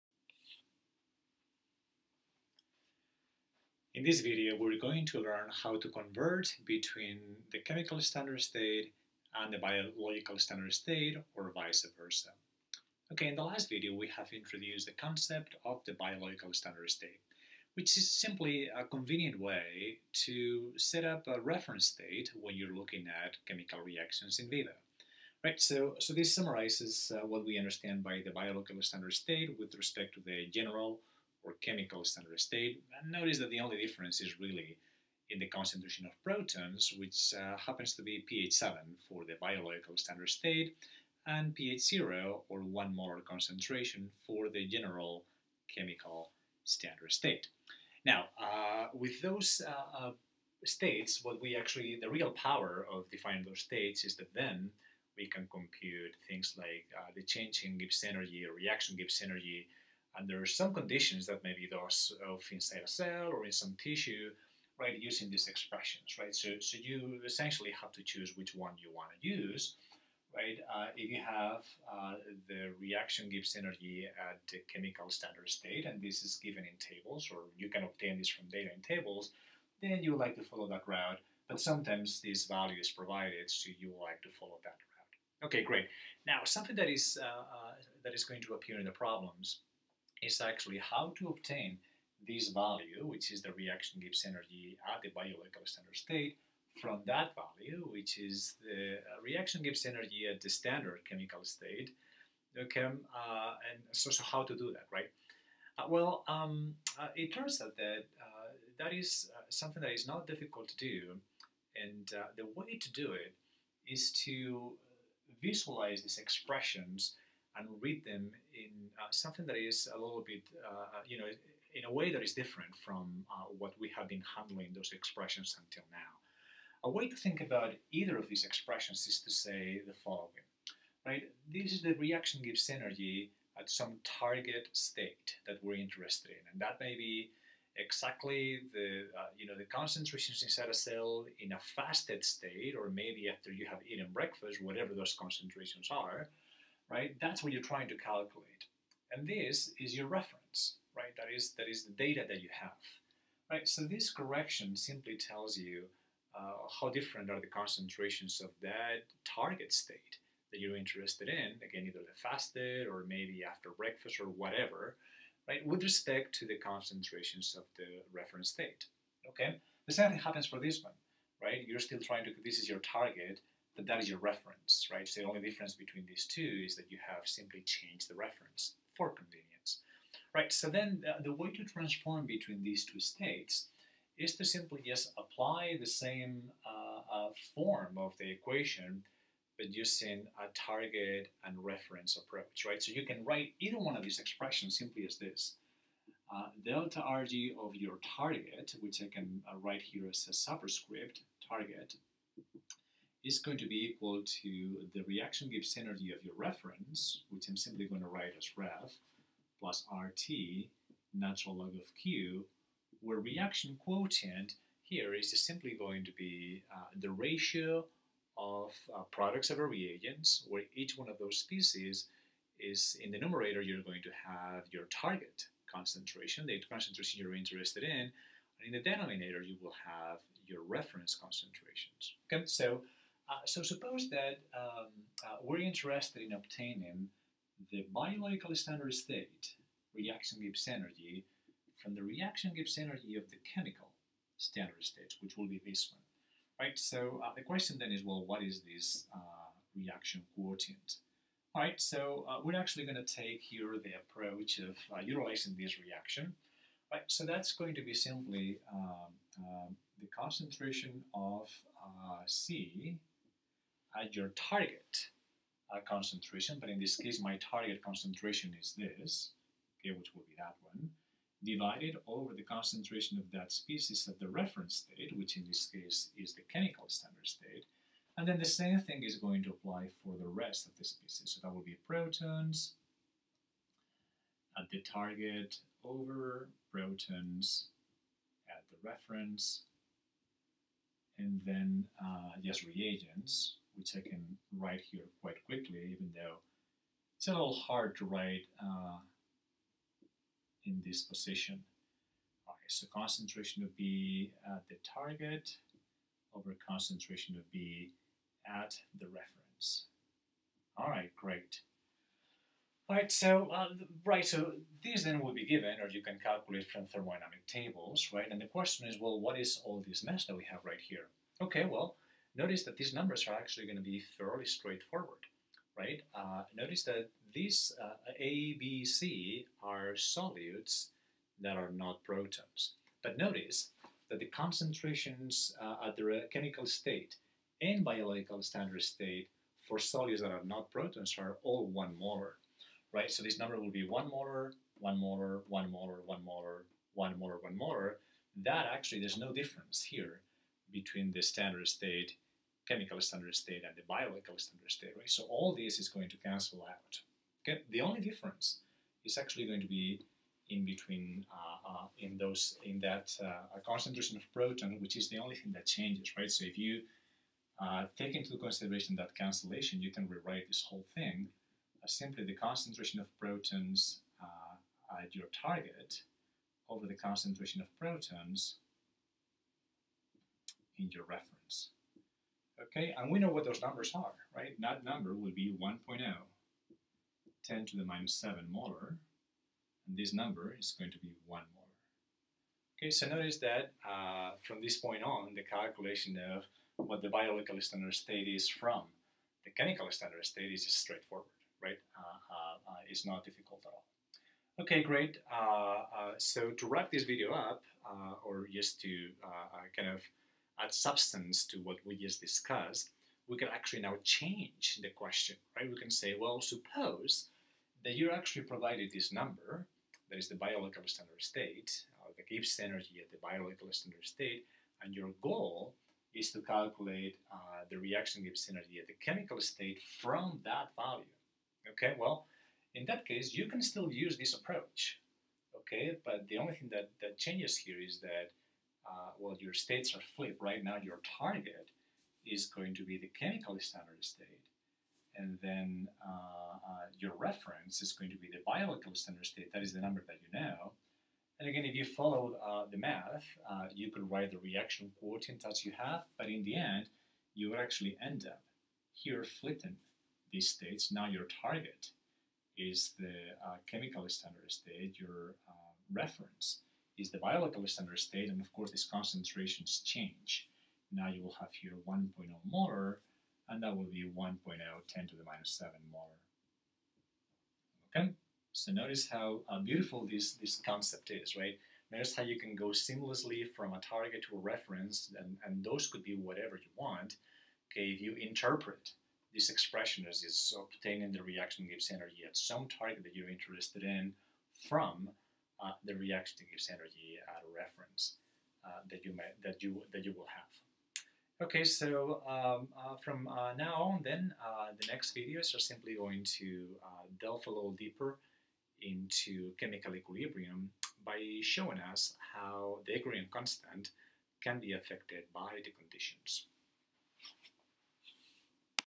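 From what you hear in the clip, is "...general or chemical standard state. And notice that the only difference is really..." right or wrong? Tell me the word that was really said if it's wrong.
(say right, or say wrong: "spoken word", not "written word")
right.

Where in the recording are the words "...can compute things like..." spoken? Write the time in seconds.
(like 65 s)
55 s.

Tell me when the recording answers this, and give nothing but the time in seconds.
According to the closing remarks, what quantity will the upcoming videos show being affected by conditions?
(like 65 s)
512 s.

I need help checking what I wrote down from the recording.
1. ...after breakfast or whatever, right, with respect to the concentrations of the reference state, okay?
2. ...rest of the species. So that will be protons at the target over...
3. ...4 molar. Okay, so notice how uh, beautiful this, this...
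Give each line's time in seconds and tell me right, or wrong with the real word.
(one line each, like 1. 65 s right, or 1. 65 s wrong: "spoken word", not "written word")
1. 163 s right
2. 280 s right
3. 475 s wrong: "7", not "4".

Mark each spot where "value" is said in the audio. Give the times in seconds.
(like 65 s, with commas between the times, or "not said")
82 s, 92 s, 97 s, 430 s.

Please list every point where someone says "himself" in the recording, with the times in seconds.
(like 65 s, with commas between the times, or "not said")
not said.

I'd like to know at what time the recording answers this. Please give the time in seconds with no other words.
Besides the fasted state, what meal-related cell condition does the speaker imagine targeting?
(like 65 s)
143 s.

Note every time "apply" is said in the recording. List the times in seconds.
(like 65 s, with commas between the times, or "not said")
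185 s, 279 s.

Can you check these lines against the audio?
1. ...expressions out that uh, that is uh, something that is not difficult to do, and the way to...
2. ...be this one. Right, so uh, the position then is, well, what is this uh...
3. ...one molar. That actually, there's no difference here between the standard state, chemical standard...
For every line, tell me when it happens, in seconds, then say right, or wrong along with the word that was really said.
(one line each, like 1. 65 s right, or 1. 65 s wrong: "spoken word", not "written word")
1. 107 s wrong: "turns", not "expressions"
2. 245 s wrong: "question", not "position"
3. 347 s right.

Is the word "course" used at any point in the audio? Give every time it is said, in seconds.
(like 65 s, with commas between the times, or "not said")
468 s.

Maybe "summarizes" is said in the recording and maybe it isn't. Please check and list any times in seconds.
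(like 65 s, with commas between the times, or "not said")
26 s.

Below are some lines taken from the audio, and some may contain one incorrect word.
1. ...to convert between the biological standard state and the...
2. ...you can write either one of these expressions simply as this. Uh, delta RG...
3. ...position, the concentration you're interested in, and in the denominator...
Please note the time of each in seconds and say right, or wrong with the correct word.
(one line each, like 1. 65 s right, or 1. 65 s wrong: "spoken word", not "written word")
1. 5 s wrong: "chemical", not "biological"
2. 192 s right
3. 225 s wrong: "concentration", not "position".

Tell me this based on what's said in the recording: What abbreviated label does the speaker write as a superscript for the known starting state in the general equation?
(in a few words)
ref.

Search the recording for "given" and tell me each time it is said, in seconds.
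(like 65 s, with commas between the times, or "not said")
76 s, 315 s.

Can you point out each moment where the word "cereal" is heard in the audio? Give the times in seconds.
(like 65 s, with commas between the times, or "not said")
not said.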